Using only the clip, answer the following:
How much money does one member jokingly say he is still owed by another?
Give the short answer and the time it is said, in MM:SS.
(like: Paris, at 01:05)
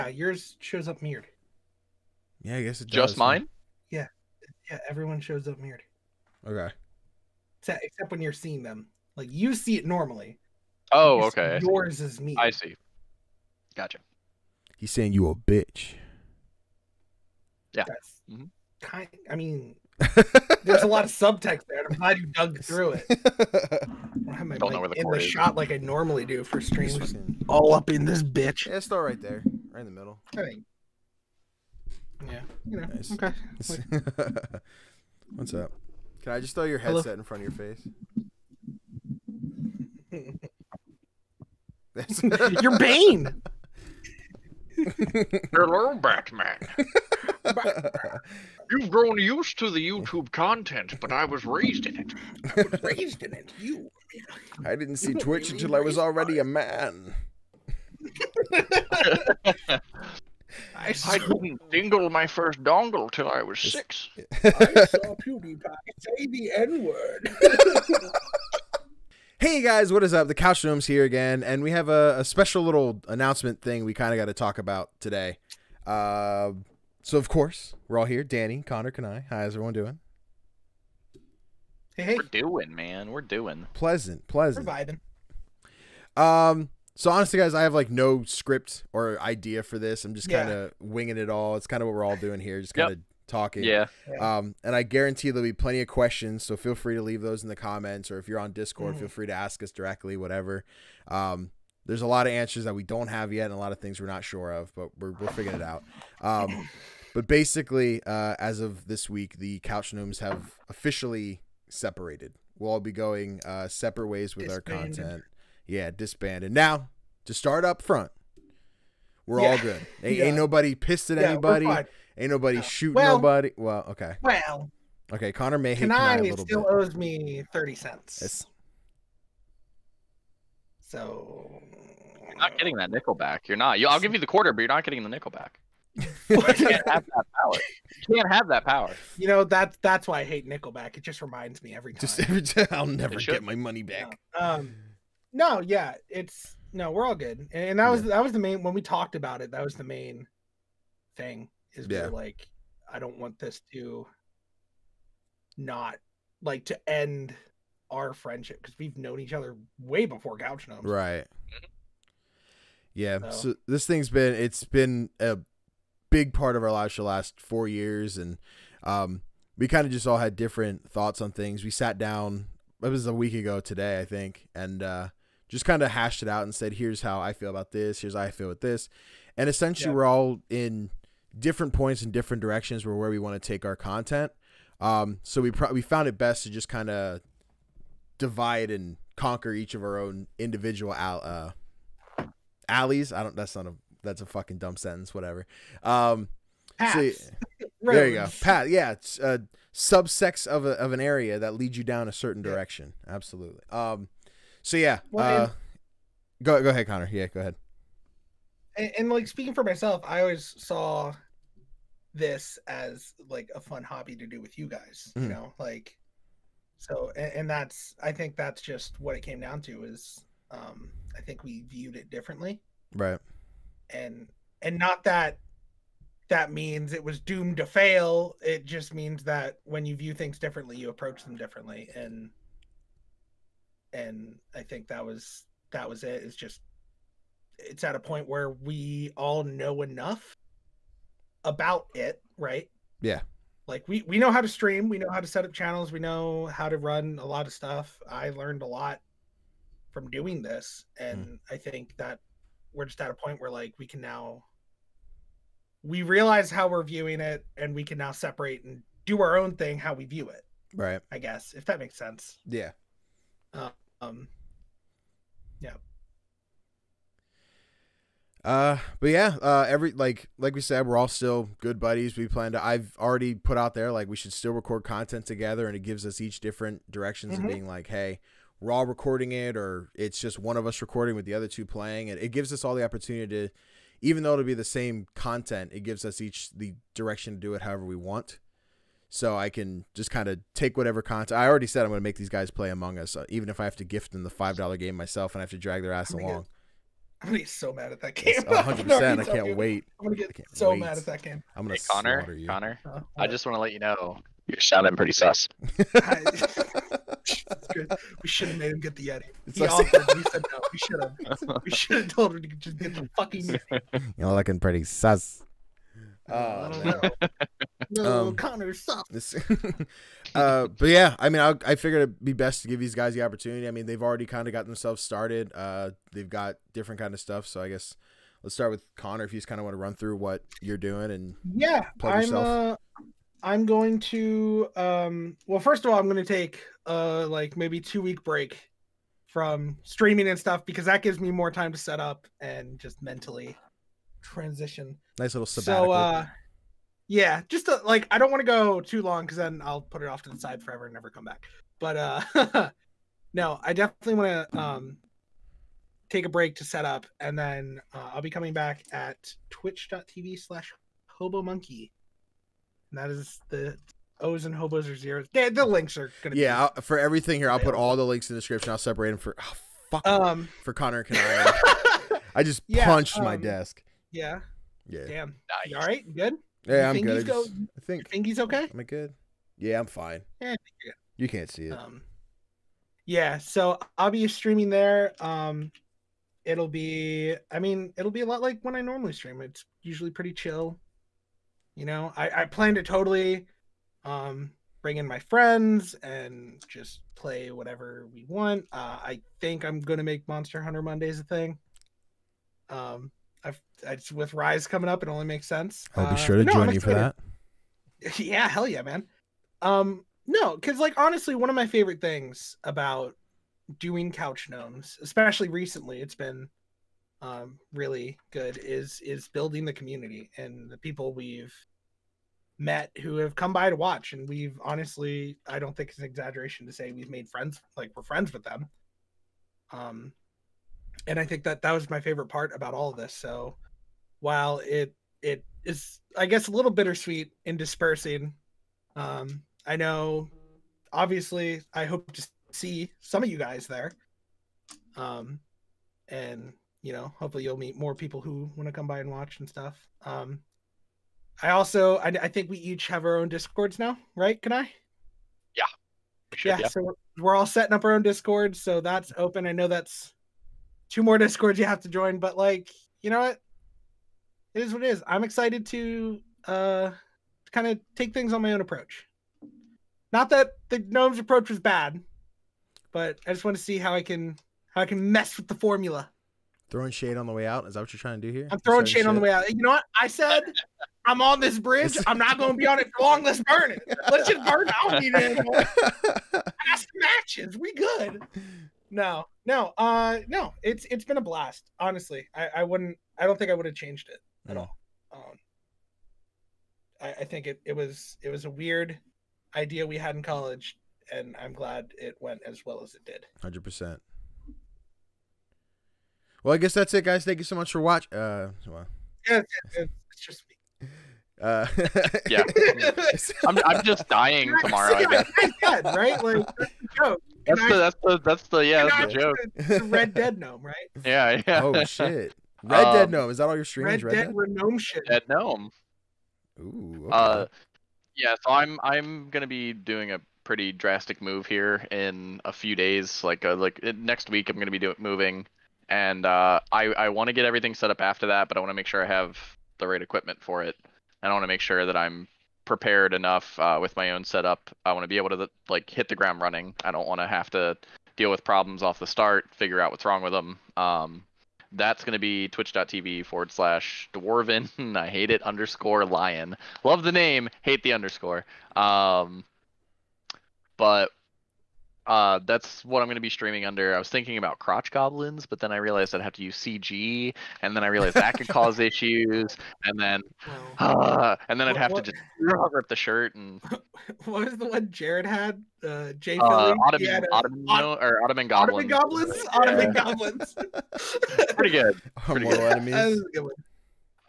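30 cents, at 02:07.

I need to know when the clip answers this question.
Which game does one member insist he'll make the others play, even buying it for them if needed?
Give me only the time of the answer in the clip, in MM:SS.
04:52.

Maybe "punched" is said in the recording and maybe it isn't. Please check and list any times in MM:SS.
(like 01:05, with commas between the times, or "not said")
06:12.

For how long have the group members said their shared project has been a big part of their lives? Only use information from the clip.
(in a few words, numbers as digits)
4 years.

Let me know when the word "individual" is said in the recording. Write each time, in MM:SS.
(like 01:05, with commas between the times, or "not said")
03:10.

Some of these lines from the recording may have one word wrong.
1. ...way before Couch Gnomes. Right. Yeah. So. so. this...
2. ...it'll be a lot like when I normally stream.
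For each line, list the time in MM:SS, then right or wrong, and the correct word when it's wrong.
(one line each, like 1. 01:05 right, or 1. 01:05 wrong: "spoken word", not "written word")
1. 02:39 right
2. 06:27 right.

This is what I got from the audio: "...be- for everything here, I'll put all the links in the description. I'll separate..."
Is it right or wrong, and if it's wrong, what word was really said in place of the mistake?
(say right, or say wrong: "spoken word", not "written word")
right.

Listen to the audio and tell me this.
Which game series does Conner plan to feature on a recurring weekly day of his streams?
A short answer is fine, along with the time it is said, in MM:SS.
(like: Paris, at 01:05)
Monster Hunter, at 06:40.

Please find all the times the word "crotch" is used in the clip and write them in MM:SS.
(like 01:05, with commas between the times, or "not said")
09:24.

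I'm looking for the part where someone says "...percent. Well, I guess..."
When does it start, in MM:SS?
08:23.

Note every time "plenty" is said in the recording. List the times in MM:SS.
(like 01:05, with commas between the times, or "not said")
01:35.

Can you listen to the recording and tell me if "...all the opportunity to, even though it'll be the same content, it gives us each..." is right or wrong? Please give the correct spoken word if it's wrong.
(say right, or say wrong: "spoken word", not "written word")
right.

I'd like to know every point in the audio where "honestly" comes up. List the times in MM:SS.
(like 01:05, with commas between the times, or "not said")
01:27, 06:50, 07:04, 08:11.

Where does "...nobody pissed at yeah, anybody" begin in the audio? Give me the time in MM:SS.
02:00.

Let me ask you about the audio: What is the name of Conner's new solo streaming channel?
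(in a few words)
Hobo Monkey.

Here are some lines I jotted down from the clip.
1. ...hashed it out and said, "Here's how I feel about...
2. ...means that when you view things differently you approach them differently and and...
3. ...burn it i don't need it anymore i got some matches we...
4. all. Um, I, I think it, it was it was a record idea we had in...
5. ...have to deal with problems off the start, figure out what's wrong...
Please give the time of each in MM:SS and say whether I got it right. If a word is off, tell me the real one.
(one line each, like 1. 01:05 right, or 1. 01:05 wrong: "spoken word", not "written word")
1. 02:55 right
2. 03:48 right
3. 08:04 right
4. 08:14 wrong: "weird", not "record"
5. 09:07 right.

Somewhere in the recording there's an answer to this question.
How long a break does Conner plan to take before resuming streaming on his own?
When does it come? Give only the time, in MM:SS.
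05:37.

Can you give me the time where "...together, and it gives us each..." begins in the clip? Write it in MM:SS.
04:35.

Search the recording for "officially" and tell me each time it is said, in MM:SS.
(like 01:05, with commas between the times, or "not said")
01:50.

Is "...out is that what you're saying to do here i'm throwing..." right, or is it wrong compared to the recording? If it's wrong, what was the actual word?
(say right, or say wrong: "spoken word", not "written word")
wrong: "trying", not "saying".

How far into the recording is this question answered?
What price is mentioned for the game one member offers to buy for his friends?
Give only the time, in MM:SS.
04:54.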